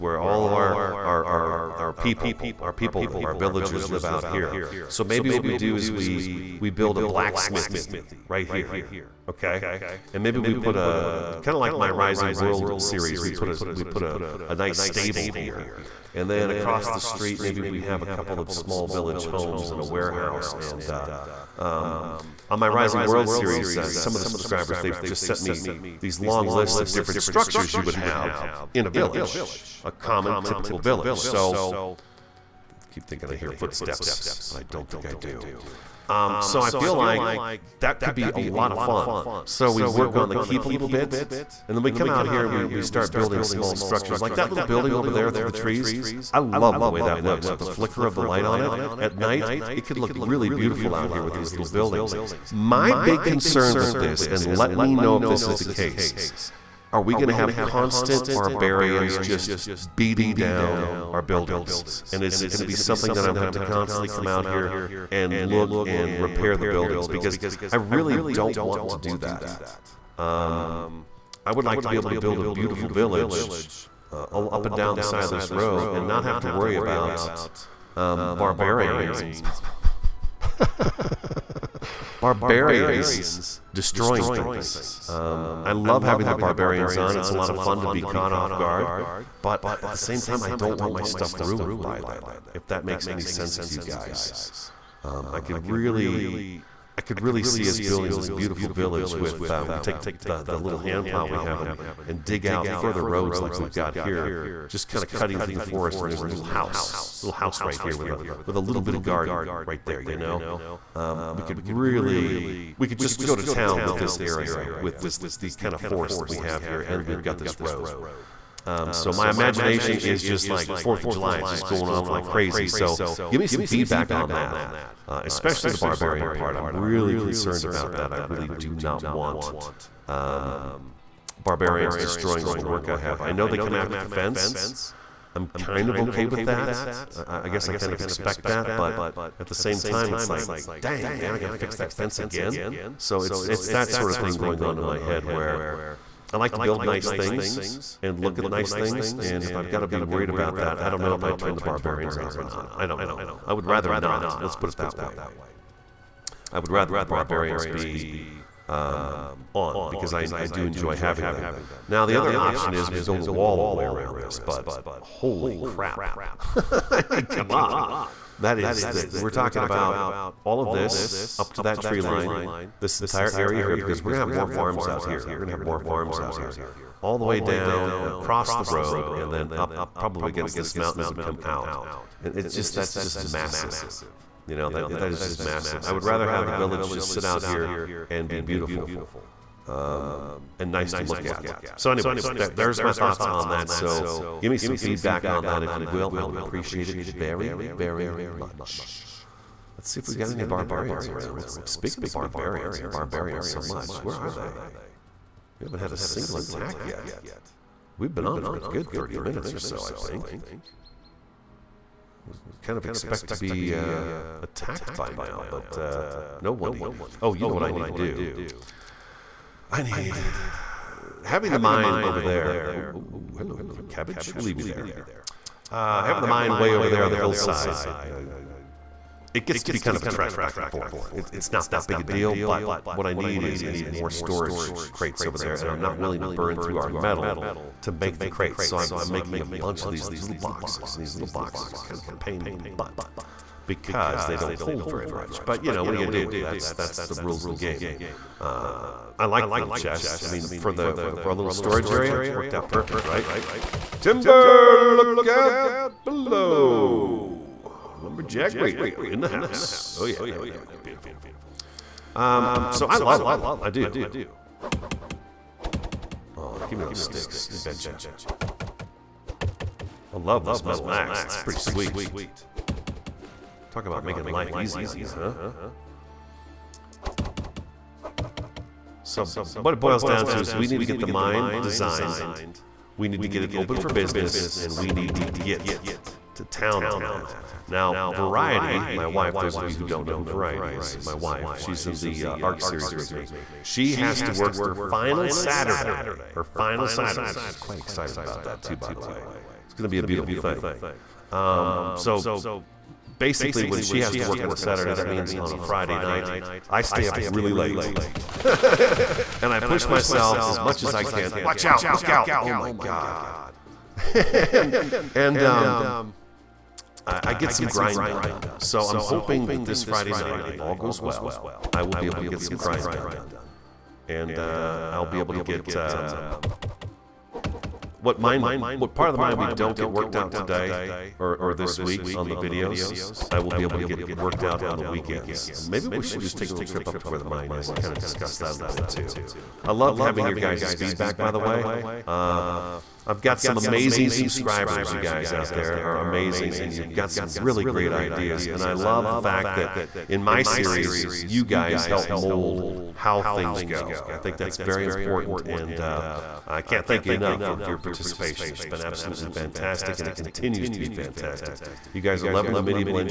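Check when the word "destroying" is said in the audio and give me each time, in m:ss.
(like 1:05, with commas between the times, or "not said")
1:23, 2:11.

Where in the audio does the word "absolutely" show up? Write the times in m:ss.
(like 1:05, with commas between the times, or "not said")
5:58.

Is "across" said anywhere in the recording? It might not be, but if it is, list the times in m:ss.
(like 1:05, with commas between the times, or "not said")
0:16, 2:58.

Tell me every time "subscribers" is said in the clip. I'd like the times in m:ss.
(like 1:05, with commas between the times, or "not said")
0:24, 5:44.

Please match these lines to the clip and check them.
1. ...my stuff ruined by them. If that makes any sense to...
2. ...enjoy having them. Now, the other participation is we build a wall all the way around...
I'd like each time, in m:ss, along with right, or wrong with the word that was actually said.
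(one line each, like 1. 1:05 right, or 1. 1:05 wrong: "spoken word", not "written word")
1. 1:30 right
2. 2:40 wrong: "option", not "participation".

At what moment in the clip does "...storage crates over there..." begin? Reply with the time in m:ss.
3:54.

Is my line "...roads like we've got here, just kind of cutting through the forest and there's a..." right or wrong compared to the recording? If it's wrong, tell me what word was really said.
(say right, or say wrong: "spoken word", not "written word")
right.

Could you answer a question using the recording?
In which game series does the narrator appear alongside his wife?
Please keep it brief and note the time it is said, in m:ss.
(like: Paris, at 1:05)
ARK, at 4:52.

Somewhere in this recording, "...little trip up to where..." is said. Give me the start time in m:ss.
5:36.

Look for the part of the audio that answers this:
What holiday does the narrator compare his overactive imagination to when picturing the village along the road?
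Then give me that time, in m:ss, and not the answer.
2:00.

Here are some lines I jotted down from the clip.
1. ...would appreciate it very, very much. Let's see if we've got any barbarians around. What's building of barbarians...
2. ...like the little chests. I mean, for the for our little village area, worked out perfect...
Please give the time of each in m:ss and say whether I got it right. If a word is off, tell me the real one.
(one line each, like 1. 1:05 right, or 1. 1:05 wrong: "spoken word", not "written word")
1. 3:16 wrong: "speaking", not "building"
2. 4:09 wrong: "storage", not "village".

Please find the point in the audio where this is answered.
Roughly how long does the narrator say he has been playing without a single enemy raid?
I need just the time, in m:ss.
3:28.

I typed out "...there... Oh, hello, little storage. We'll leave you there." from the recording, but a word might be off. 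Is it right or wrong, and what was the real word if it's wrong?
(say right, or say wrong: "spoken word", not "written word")
wrong: "cabbage", not "storage".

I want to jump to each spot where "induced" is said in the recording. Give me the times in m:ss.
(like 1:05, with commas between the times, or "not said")
not said.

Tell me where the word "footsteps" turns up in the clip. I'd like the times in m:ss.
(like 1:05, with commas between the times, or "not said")
0:33.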